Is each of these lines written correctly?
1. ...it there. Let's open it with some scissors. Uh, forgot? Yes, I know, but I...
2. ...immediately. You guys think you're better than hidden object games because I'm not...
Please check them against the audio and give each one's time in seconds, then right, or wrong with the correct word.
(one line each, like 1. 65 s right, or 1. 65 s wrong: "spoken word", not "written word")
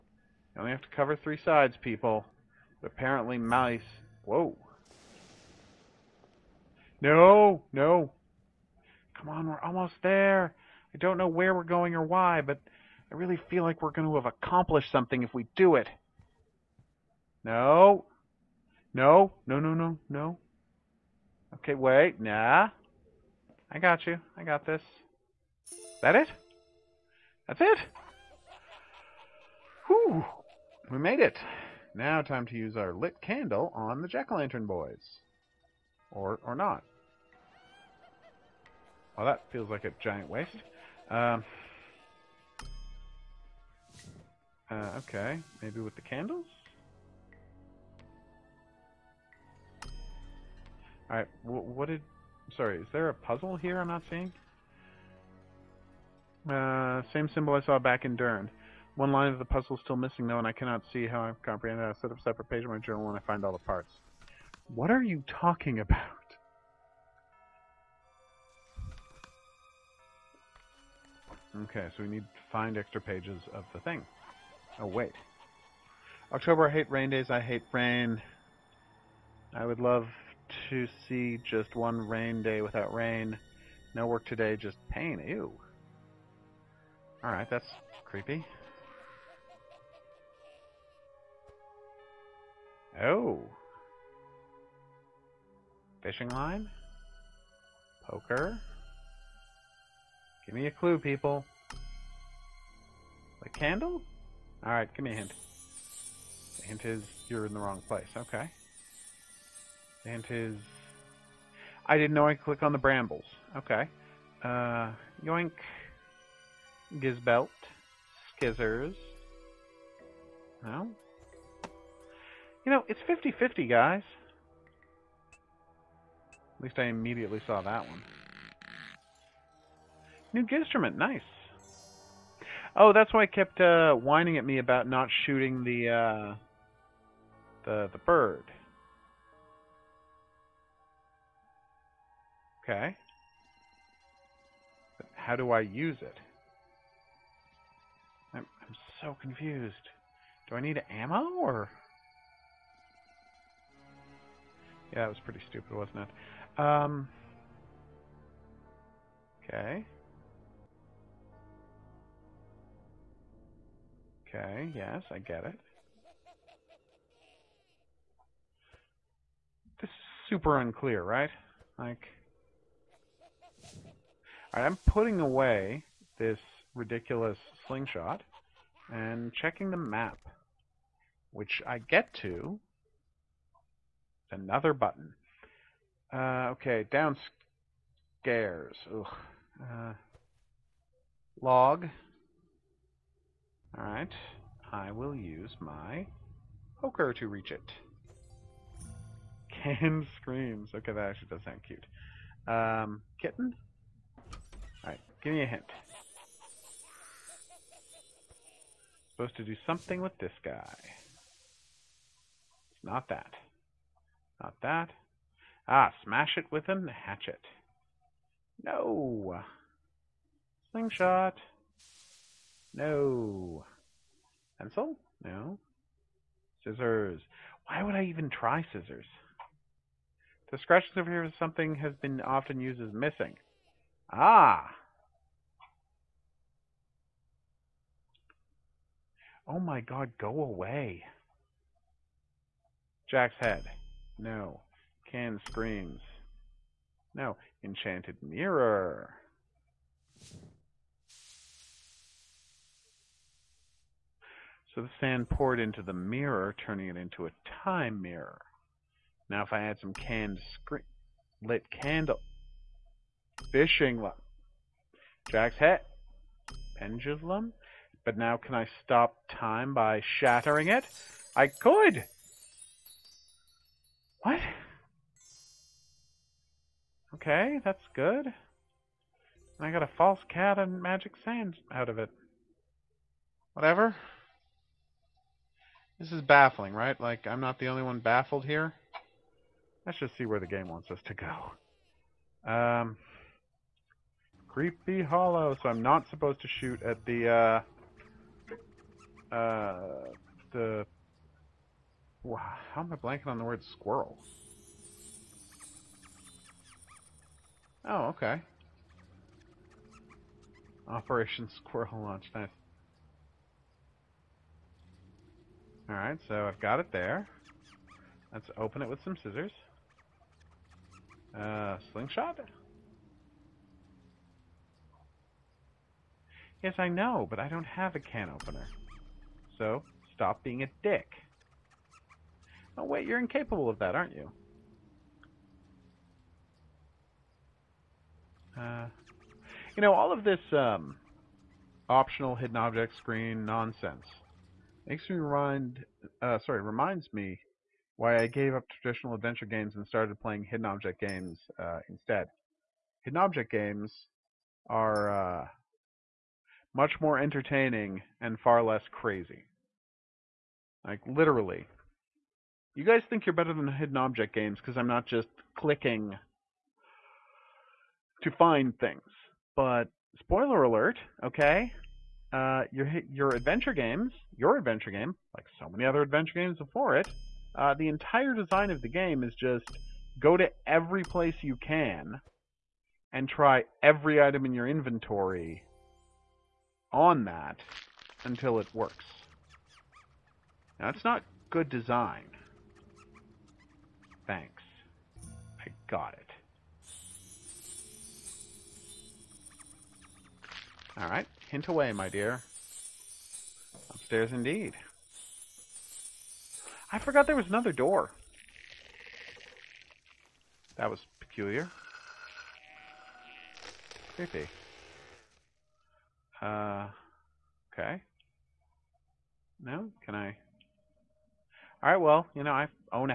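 1. 316 s wrong: "slingshot", not "forgot"
2. 361 s wrong: "literally", not "immediately".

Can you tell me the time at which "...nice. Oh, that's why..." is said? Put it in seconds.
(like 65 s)
130 s.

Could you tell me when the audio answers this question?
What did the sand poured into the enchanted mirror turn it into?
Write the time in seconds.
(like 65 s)
257 s.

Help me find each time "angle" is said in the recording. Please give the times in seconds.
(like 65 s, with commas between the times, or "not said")
not said.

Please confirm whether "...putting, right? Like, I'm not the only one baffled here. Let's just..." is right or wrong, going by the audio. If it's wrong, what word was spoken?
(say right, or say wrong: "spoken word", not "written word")
wrong: "baffling", not "putting".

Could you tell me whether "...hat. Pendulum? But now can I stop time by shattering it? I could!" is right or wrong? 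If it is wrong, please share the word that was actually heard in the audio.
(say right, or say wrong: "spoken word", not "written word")
right.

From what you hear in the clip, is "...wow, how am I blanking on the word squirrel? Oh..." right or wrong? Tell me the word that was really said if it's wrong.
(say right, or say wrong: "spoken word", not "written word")
right.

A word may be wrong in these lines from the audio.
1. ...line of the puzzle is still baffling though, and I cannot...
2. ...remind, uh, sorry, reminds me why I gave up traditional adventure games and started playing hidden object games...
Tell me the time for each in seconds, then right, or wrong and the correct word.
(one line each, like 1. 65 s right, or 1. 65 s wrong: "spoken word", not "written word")
1. 59 s wrong: "missing", not "baffling"
2. 345 s right.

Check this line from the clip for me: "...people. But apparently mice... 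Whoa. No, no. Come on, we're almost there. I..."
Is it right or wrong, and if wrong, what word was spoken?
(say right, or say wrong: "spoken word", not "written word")
right.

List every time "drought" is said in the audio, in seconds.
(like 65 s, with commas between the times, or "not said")
not said.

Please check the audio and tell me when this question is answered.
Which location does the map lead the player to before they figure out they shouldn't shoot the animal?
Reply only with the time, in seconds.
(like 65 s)
294 s.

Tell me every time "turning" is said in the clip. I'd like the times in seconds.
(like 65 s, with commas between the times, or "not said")
256 s.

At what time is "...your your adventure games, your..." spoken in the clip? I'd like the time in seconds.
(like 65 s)
372 s.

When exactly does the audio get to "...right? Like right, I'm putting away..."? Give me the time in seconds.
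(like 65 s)
171 s.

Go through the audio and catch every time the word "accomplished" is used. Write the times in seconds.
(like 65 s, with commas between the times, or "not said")
14 s.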